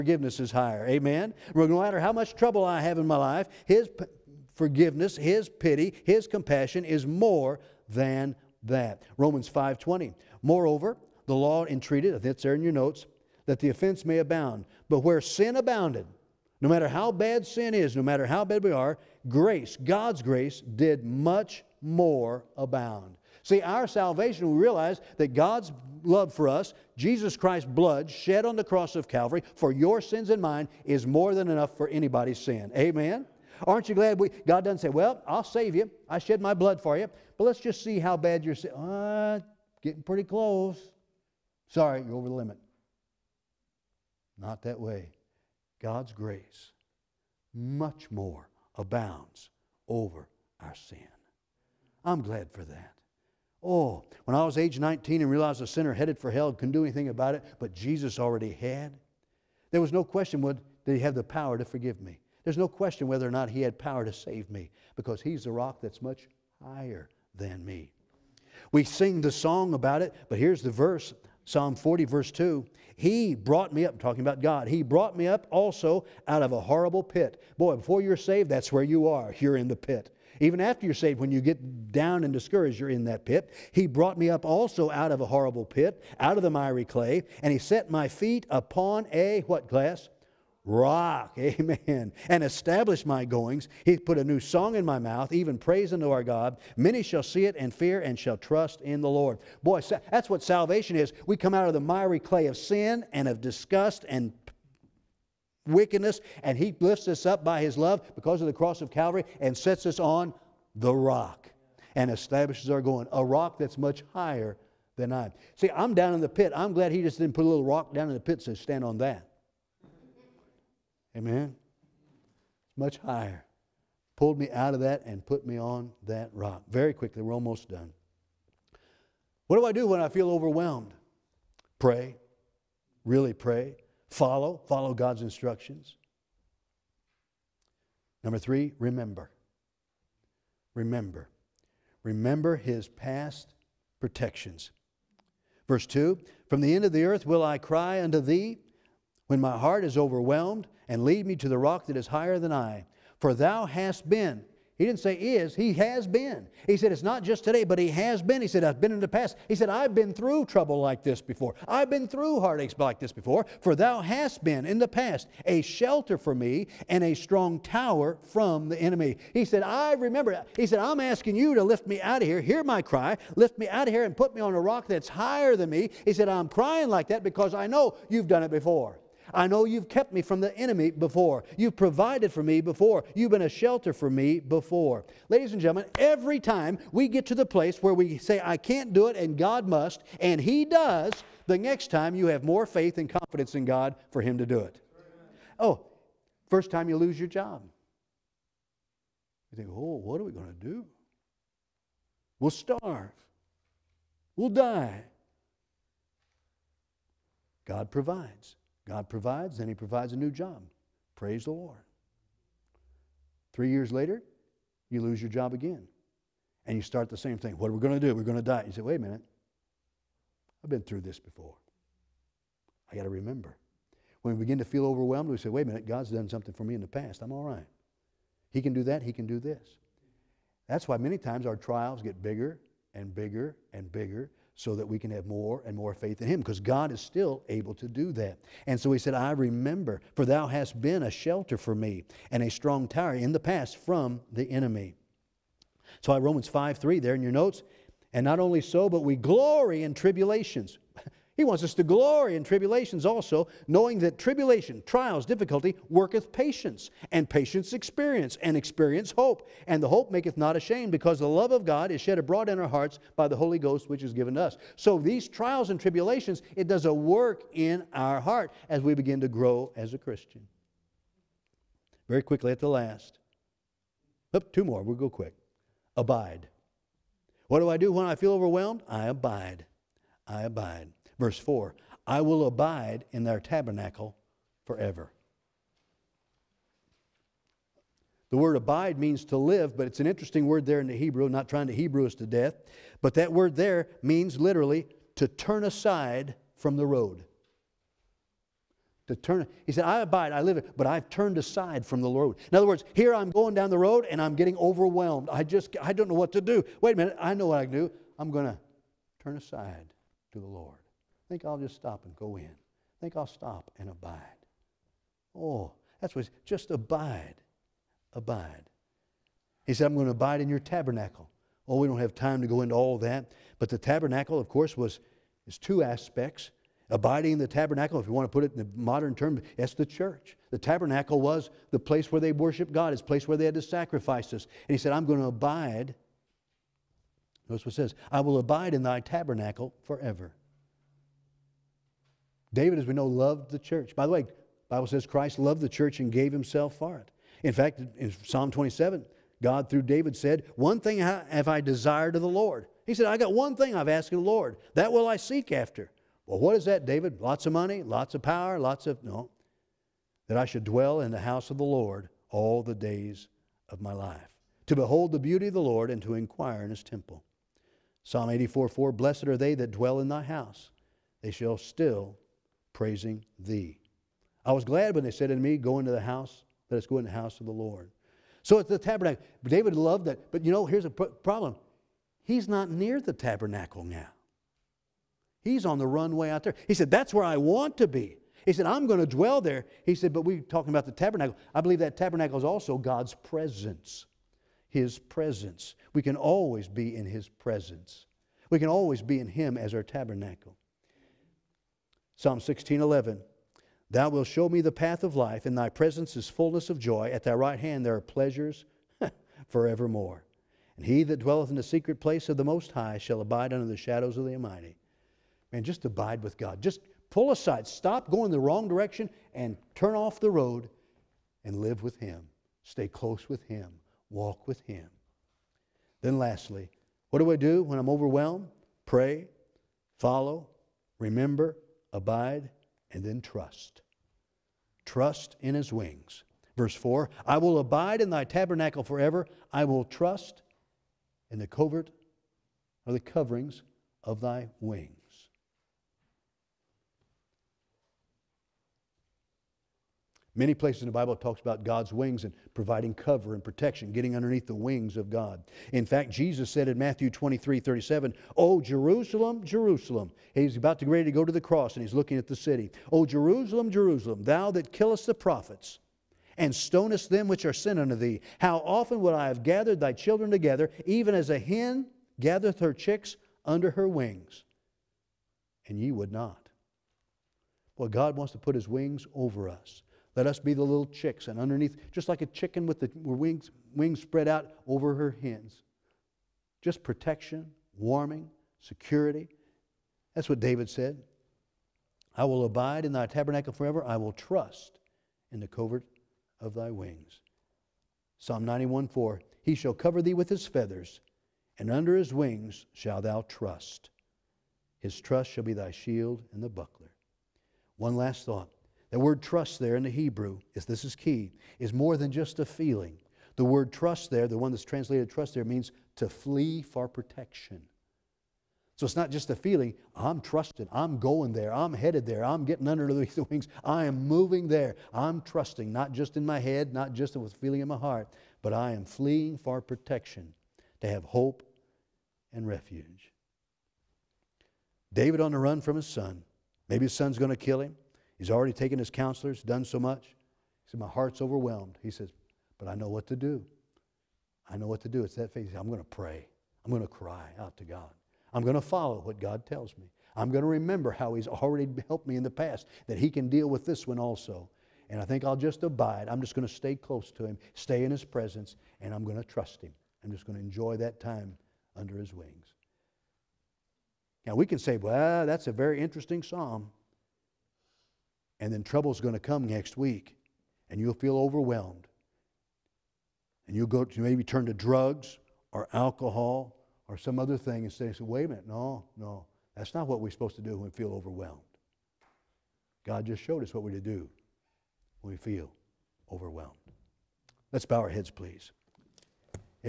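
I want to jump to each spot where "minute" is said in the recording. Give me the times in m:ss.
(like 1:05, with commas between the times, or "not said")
3:38, 3:45, 5:06, 9:38.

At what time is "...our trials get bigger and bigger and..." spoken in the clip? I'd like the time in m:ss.
3:51.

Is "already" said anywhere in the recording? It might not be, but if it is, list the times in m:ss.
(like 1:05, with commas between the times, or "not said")
0:58, 8:58, 9:11.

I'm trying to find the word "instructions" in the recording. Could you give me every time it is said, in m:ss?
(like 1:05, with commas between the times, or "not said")
2:15.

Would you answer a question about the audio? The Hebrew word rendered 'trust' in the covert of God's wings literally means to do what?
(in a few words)
Flee for protection.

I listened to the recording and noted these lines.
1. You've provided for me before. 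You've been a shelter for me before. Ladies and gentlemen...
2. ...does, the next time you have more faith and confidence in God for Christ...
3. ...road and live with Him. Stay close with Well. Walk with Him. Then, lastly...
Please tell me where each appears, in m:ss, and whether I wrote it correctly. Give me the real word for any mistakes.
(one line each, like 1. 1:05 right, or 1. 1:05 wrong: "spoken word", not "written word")
1. 3:01 right
2. 3:10 wrong: "Him", not "Christ"
3. 7:00 wrong: "Him", not "Well".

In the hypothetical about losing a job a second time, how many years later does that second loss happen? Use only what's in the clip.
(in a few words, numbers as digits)
3 years.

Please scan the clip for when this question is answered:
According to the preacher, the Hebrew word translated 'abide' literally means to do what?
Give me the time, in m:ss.
4:55.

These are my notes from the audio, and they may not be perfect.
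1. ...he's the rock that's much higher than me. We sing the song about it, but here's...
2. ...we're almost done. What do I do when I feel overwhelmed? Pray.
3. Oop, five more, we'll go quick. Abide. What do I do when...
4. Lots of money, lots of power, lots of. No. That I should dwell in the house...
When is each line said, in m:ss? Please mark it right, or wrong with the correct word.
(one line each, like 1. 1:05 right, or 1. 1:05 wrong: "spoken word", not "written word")
1. 1:05 right
2. 2:07 right
3. 4:34 wrong: "two", not "five"
4. 5:57 right.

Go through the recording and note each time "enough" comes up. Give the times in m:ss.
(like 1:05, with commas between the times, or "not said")
0:31.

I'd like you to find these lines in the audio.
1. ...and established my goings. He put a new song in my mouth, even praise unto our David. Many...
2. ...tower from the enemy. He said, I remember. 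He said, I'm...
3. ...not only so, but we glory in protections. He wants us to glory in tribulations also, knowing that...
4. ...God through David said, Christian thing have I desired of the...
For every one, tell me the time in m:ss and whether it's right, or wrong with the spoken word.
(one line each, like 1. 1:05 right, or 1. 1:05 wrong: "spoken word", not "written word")
1. 1:32 wrong: "God", not "David"
2. 2:47 right
3. 4:08 wrong: "tribulations", not "protections"
4. 5:49 wrong: "One", not "Christian".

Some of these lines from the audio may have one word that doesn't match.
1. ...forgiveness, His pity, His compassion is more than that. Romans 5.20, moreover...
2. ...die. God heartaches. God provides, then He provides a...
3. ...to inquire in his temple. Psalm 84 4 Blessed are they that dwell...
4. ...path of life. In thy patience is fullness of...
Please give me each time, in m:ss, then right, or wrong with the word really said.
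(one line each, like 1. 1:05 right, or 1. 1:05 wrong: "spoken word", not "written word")
1. 0:04 right
2. 3:24 wrong: "provides", not "heartaches"
3. 6:06 right
4. 6:44 wrong: "presence", not "patience".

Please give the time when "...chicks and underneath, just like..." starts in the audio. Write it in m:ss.
8:00.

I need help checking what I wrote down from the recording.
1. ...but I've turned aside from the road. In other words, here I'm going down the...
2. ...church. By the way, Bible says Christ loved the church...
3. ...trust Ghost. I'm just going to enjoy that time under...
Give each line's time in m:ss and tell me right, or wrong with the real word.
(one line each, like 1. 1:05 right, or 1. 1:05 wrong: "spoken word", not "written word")
1. 5:00 right
2. 5:43 right
3. 9:19 wrong: "Him", not "Ghost".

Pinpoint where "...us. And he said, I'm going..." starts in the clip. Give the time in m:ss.
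5:34.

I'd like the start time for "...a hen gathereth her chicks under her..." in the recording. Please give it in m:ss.
7:51.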